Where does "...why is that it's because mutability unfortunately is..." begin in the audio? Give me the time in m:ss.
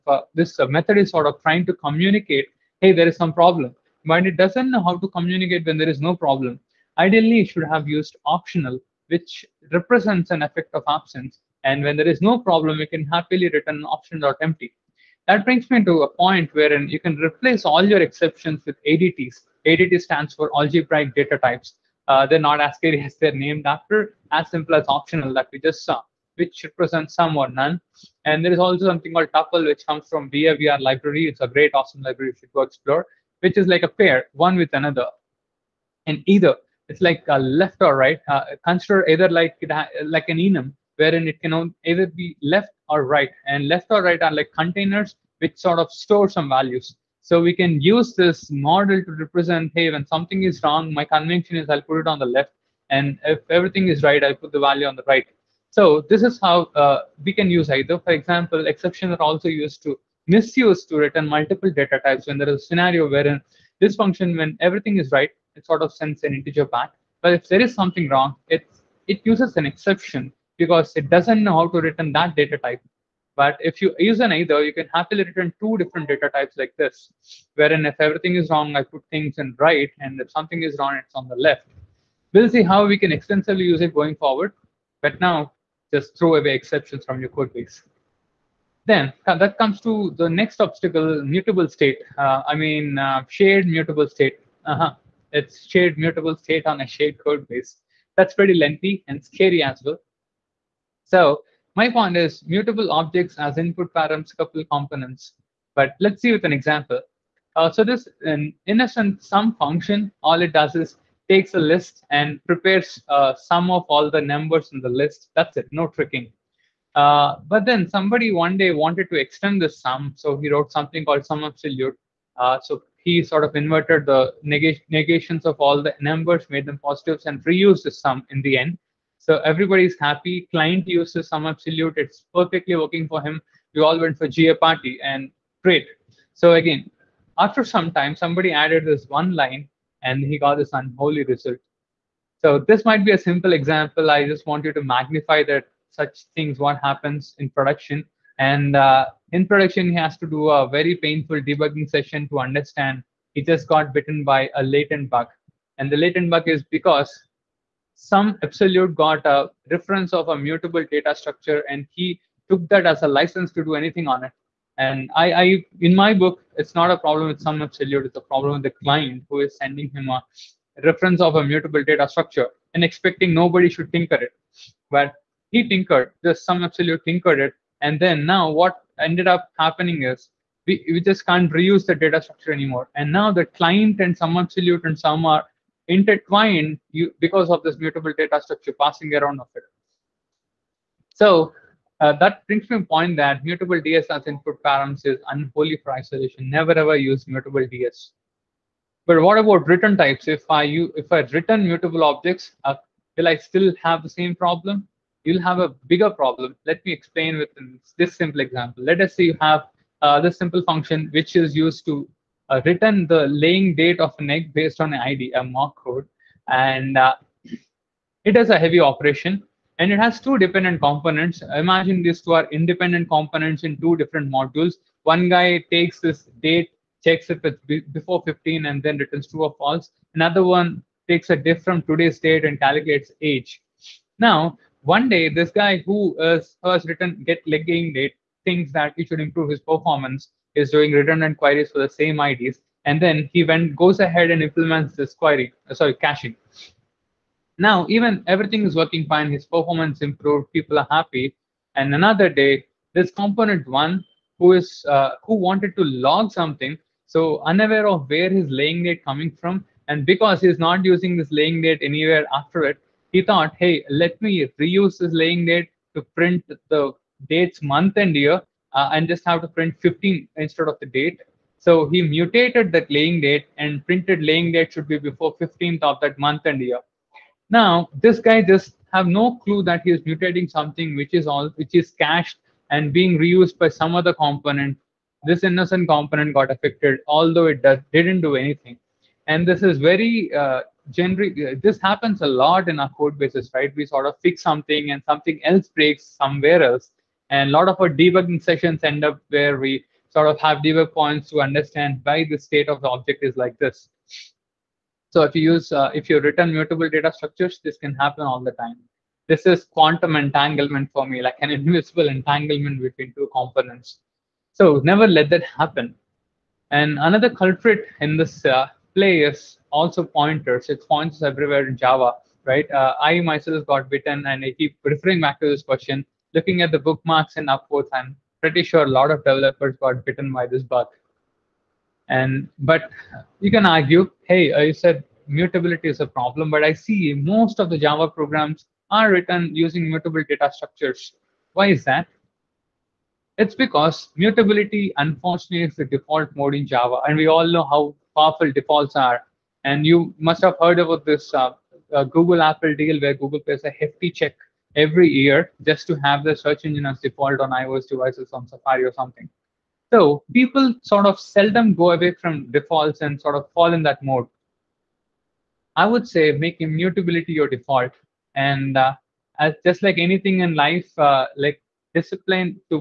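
5:41.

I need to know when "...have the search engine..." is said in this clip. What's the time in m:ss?
5:56.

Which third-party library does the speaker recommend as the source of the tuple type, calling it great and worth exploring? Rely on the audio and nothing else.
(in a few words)
VAVR.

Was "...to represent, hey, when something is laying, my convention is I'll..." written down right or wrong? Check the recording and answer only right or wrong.
wrong.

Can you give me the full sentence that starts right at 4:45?
This innocent component got affected, although it does, didn't do anything.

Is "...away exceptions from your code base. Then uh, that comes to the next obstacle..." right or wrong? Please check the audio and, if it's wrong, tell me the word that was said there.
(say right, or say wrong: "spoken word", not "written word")
right.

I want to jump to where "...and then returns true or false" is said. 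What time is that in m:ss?
3:48.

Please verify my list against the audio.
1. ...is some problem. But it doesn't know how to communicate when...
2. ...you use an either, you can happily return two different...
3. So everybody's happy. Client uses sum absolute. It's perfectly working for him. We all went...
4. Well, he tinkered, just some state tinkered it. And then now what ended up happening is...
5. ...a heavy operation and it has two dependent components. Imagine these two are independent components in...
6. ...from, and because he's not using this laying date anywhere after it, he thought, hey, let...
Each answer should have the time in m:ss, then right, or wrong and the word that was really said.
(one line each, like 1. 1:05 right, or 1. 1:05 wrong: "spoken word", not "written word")
1. 0:03 right
2. 1:13 right
3. 2:09 right
4. 2:54 wrong: "absolute", not "state"
5. 3:38 right
6. 4:19 right.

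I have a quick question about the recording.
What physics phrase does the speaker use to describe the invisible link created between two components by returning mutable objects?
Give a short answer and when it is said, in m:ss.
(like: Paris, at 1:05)
quantum entanglement, at 5:09.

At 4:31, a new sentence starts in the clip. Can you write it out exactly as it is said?
So he mutated that laying date and printed laying date should be before 15th of that month and year.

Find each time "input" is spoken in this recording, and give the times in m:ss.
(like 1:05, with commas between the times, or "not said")
1:43, 3:14.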